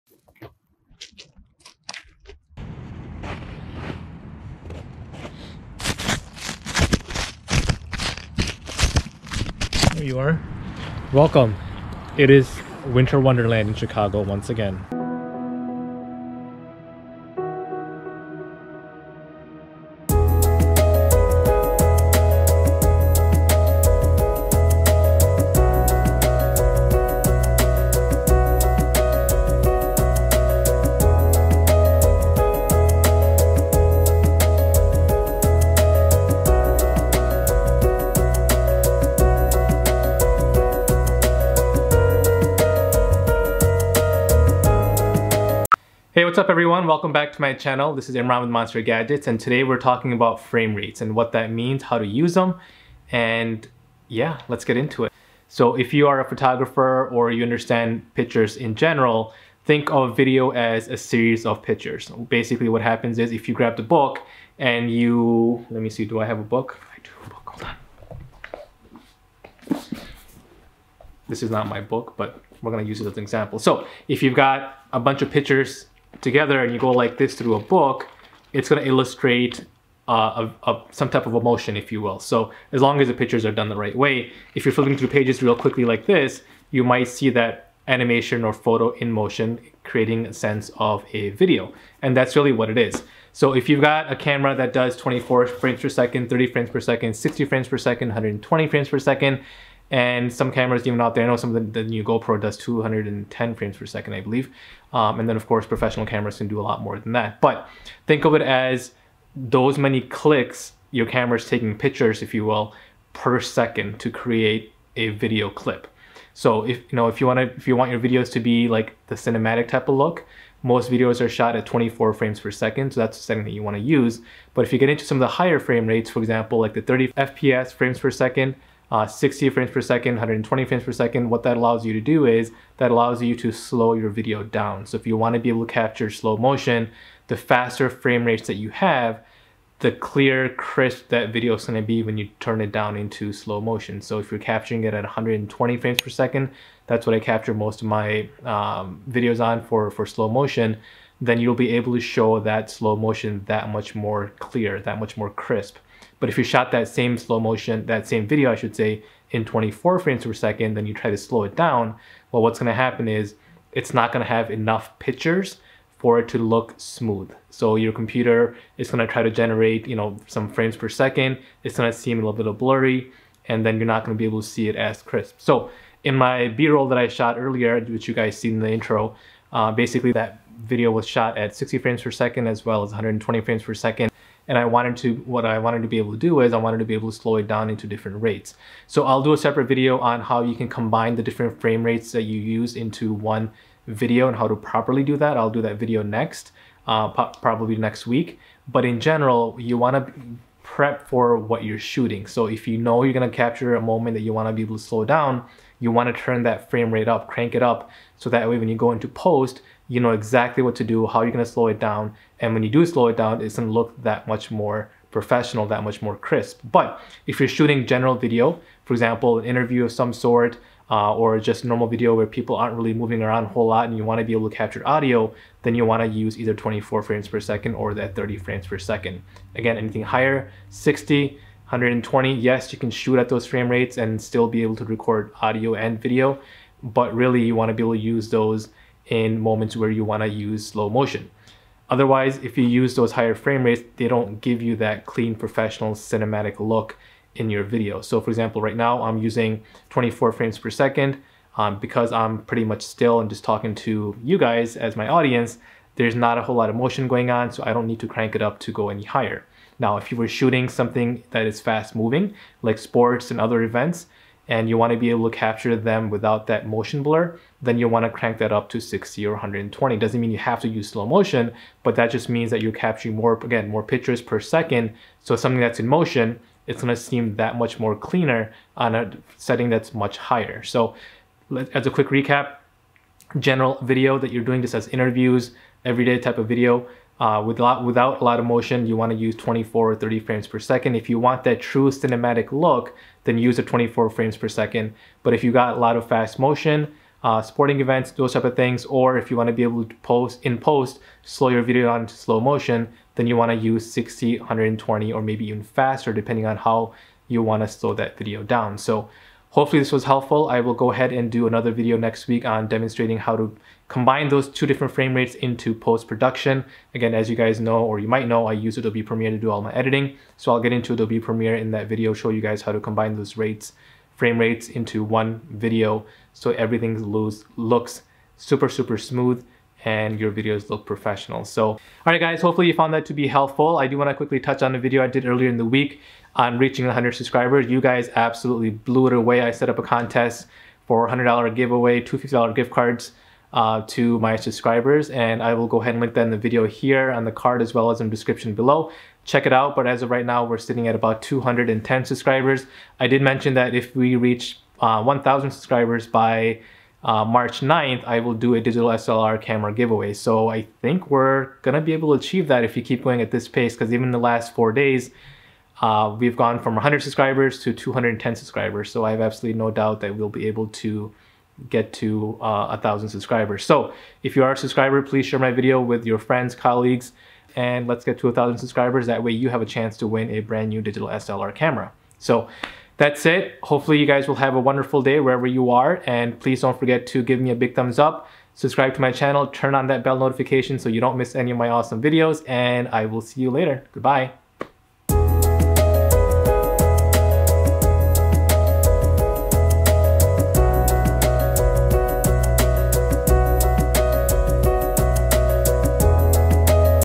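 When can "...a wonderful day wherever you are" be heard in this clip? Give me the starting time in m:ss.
6:24.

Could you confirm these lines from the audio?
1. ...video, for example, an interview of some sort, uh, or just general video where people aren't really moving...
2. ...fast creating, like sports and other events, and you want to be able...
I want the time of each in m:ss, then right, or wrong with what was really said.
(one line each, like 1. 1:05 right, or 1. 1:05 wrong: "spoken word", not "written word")
1. 3:38 wrong: "normal", not "general"
2. 4:21 wrong: "moving", not "creating".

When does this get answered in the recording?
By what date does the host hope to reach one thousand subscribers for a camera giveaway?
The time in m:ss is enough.
5:57.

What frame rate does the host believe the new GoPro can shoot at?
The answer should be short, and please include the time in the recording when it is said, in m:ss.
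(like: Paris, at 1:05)
210 frames per second, at 1:42.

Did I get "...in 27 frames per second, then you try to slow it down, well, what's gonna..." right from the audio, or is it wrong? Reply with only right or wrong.
wrong.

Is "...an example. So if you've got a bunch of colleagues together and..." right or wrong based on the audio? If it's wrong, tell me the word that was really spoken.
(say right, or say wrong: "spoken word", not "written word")
wrong: "pictures", not "colleagues".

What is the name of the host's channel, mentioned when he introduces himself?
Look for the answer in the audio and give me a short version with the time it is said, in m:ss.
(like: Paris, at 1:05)
Monster Gadgets, at 0:48.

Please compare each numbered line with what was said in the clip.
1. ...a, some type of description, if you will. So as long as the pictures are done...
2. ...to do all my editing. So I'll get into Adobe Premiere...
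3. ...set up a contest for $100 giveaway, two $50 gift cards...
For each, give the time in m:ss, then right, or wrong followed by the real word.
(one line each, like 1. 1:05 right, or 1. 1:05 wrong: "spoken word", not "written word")
1. 1:20 wrong: "emotion", not "description"
2. 5:19 right
3. 5:39 right.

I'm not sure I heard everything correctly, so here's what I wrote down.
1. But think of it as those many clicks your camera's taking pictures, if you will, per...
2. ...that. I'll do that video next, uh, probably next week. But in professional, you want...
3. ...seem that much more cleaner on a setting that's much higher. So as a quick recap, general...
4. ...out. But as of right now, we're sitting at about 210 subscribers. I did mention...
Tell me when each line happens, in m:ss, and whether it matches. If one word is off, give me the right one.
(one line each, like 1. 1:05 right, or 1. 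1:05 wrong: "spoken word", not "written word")
1. 1:47 right
2. 3:15 wrong: "general", not "professional"
3. 4:36 right
4. 5:49 right.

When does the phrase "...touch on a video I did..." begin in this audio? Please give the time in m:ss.
5:34.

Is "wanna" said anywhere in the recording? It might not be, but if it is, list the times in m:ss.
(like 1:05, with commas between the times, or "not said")
2:15, 5:33.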